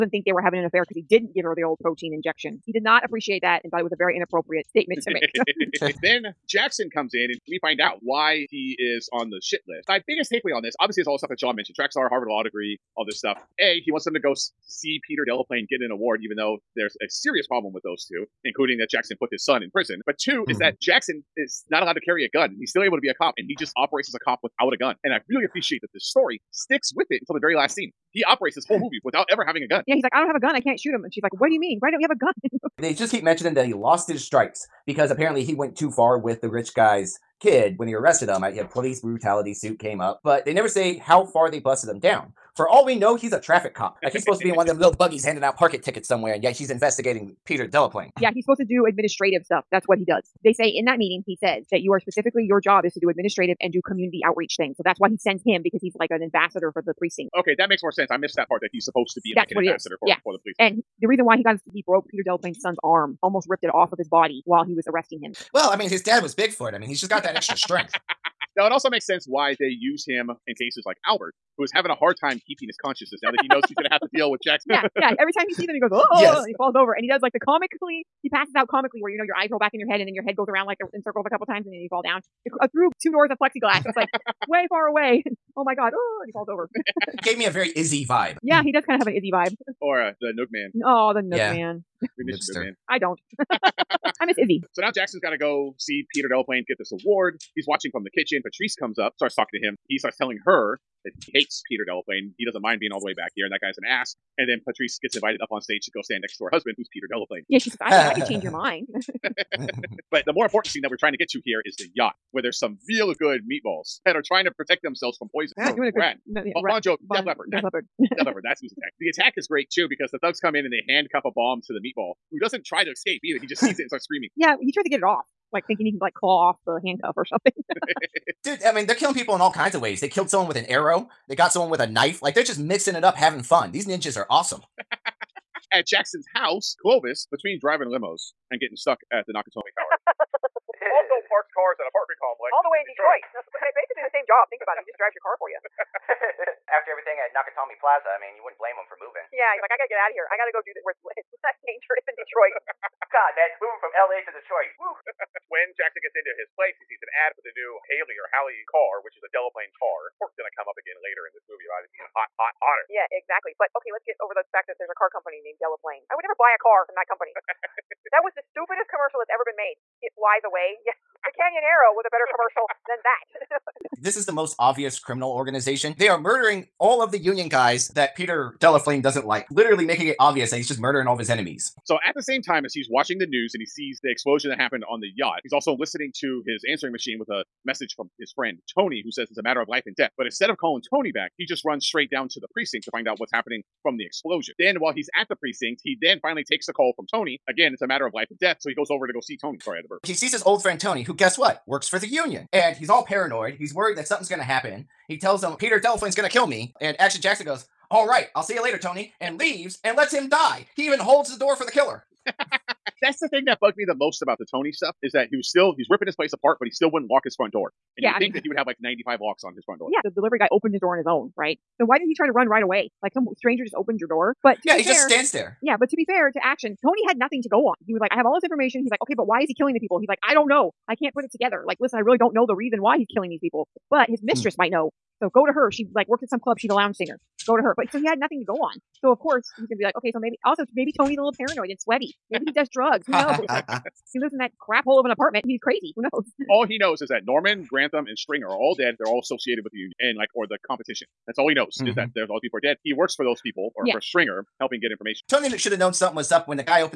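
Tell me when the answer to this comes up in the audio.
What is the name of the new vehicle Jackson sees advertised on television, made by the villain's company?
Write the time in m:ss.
2:37.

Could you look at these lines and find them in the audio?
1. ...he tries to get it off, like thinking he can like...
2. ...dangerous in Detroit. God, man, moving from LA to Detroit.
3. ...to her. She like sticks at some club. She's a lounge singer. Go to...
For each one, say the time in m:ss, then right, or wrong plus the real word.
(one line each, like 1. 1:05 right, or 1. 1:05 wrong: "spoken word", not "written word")
1. 2:04 right
2. 2:31 right
3. 3:55 wrong: "works", not "sticks".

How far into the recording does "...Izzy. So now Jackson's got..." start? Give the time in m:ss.
1:34.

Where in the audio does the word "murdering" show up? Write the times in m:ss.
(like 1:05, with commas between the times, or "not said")
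2:56, 3:00.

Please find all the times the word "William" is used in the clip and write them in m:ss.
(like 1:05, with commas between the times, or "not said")
not said.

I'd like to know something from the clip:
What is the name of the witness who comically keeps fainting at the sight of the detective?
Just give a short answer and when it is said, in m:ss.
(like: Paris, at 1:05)
Albert, at 1:11.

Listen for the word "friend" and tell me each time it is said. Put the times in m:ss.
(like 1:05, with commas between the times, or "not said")
3:08, 3:20.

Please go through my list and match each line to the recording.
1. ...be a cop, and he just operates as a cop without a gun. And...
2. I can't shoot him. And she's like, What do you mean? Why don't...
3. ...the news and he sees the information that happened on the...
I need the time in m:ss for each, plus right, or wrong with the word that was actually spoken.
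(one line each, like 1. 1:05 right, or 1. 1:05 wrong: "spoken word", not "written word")
1. 0:23 right
2. 0:30 right
3. 3:03 wrong: "explosion", not "information".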